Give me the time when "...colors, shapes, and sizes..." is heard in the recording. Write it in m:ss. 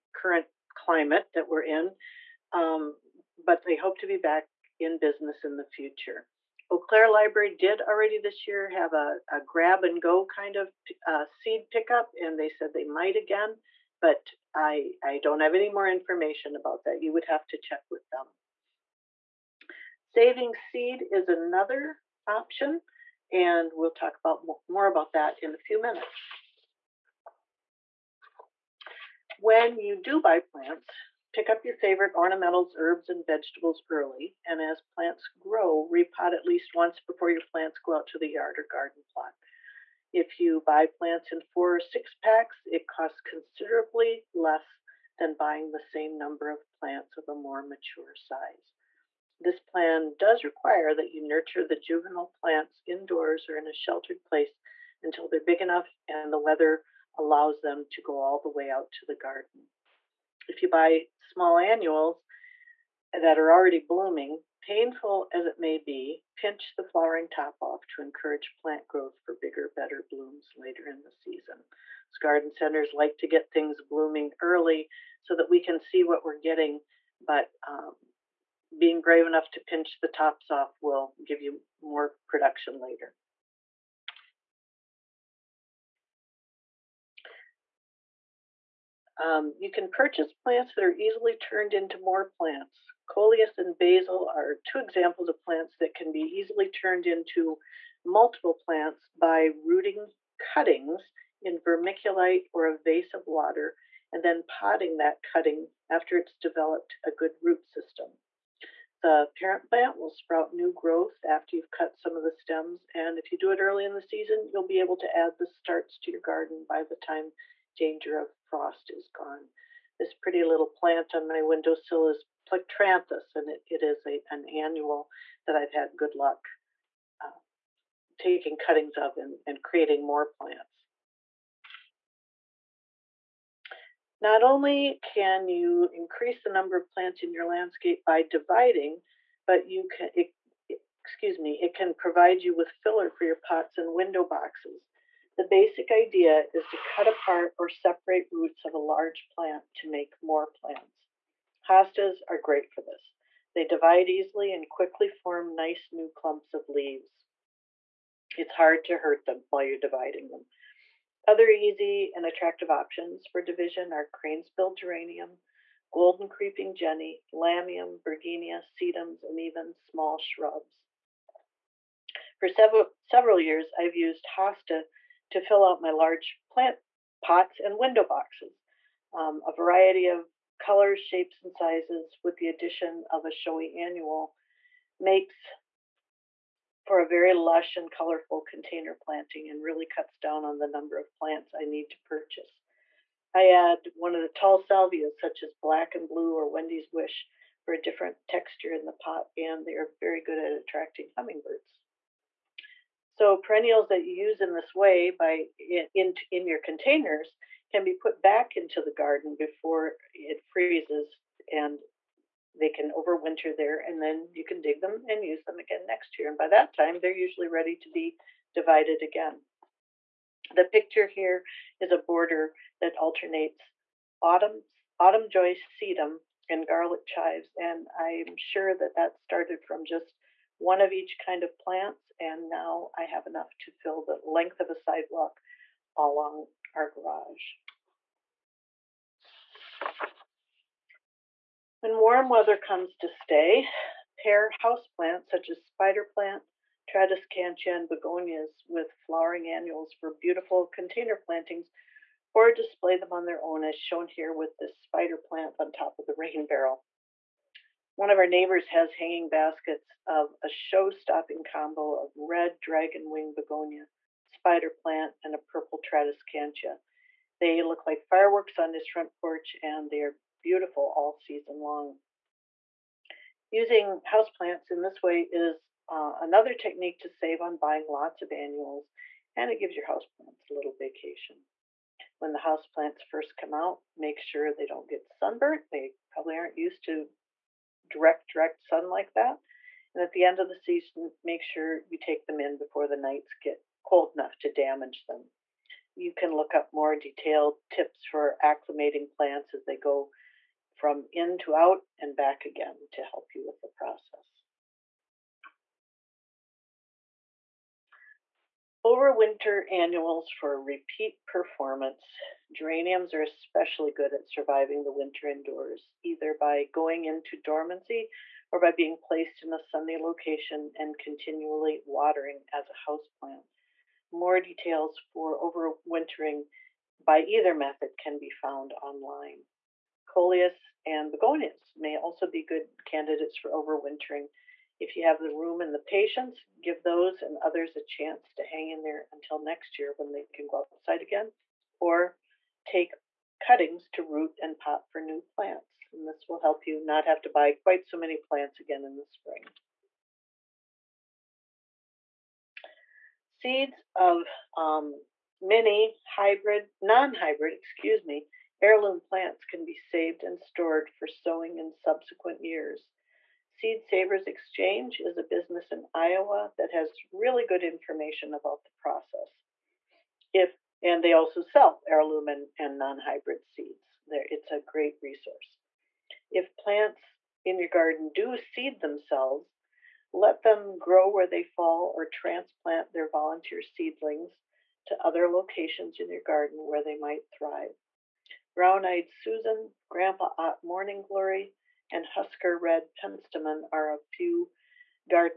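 3:00.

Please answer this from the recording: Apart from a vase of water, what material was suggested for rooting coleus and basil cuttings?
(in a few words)
vermiculite.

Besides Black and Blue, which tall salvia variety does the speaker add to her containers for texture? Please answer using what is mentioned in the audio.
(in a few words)
Wendy's Wish.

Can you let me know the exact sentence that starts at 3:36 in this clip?
And by that time, they're usually ready to be divided again.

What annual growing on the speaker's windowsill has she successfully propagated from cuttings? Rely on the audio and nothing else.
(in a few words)
Plectranthus.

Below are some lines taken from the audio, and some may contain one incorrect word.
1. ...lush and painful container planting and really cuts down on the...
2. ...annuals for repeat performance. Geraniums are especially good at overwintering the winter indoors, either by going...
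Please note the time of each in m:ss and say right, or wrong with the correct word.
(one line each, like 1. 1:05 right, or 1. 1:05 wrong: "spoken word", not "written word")
1. 3:07 wrong: "colorful", not "painful"
2. 5:09 wrong: "surviving", not "overwintering".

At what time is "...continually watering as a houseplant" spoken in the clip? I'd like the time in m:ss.
5:20.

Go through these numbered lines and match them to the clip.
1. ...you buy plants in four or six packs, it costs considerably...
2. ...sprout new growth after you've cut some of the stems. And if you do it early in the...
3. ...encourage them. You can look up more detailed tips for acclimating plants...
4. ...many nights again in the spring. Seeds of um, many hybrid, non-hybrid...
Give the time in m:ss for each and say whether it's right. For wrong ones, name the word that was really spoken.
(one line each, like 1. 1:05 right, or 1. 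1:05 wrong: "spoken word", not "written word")
1. 0:40 right
2. 1:50 right
3. 4:54 wrong: "damage", not "encourage"
4. 5:47 wrong: "plants", not "nights".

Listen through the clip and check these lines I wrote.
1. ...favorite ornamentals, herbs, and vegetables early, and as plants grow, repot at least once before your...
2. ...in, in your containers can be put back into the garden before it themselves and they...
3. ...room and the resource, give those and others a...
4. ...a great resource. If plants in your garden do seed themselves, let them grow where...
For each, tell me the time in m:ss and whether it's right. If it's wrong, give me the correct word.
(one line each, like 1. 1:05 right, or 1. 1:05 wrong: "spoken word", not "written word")
1. 0:31 right
2. 3:25 wrong: "freezes", not "themselves"
3. 5:35 wrong: "patience", not "resource"
4. 6:14 right.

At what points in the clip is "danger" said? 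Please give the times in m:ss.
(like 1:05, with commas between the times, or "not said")
1:57.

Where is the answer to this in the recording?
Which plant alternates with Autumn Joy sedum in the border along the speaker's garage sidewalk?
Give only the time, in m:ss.
3:46.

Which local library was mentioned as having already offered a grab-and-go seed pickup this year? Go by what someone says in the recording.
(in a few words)
Eau Claire Library.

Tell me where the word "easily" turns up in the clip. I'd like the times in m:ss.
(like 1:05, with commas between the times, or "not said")
1:30, 1:36, 2:34.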